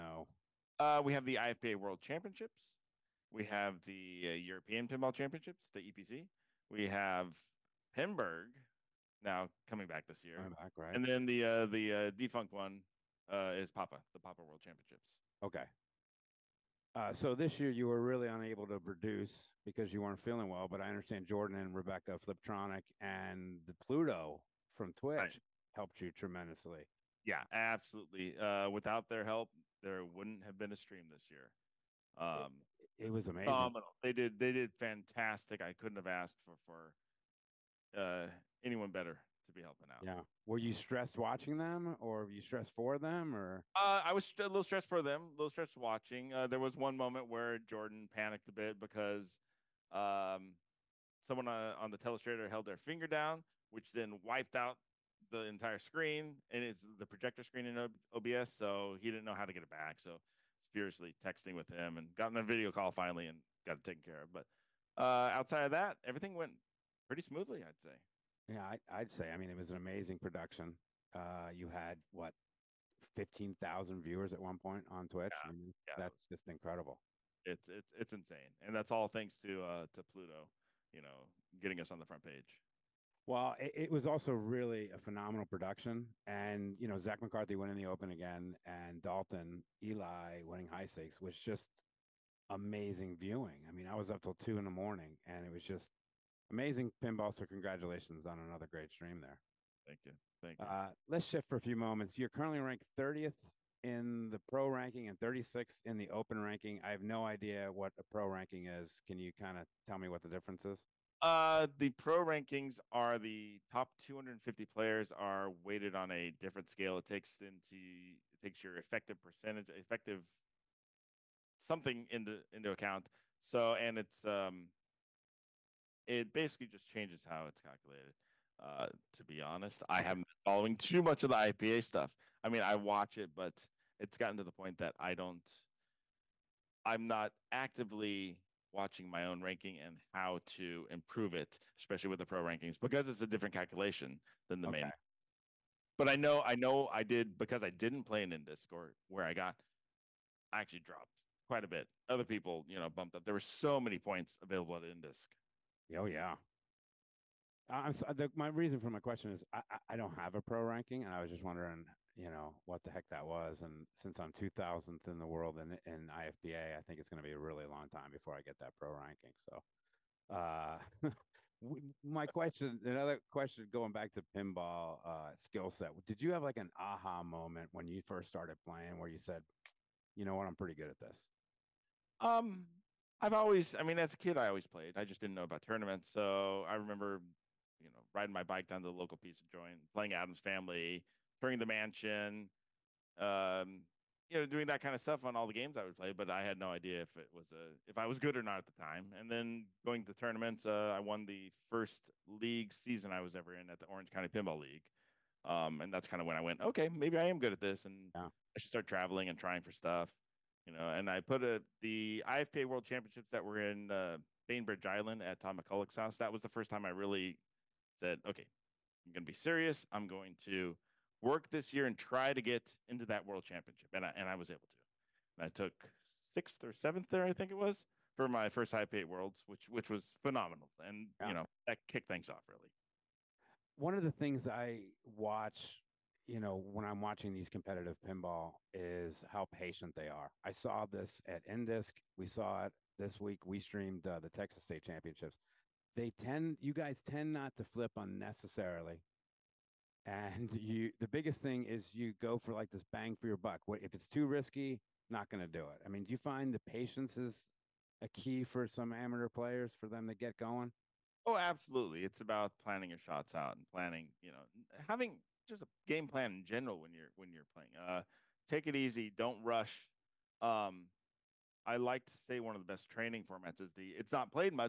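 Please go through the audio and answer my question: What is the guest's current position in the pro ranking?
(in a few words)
30th.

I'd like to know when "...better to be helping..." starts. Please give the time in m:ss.
0:38.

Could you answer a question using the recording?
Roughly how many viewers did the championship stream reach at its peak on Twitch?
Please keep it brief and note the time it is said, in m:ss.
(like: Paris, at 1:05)
15,000, at 1:13.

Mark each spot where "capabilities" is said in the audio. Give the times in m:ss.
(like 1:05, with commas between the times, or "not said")
not said.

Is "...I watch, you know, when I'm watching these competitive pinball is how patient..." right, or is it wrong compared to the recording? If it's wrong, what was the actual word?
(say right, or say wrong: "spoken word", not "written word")
right.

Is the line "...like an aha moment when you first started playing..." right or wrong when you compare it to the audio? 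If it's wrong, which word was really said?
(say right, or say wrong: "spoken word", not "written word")
right.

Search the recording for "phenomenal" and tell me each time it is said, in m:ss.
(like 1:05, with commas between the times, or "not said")
0:33, 1:24, 3:50.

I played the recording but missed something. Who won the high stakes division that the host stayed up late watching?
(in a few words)
Dalton Eli.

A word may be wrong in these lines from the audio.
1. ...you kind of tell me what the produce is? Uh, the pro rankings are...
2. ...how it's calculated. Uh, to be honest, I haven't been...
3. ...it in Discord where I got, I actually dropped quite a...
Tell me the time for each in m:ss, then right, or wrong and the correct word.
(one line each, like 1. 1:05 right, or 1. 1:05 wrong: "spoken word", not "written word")
1. 1:49 wrong: "difference", not "produce"
2. 2:07 right
3. 2:28 right.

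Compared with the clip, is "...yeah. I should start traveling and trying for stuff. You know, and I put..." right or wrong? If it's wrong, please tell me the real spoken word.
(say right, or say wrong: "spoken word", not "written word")
right.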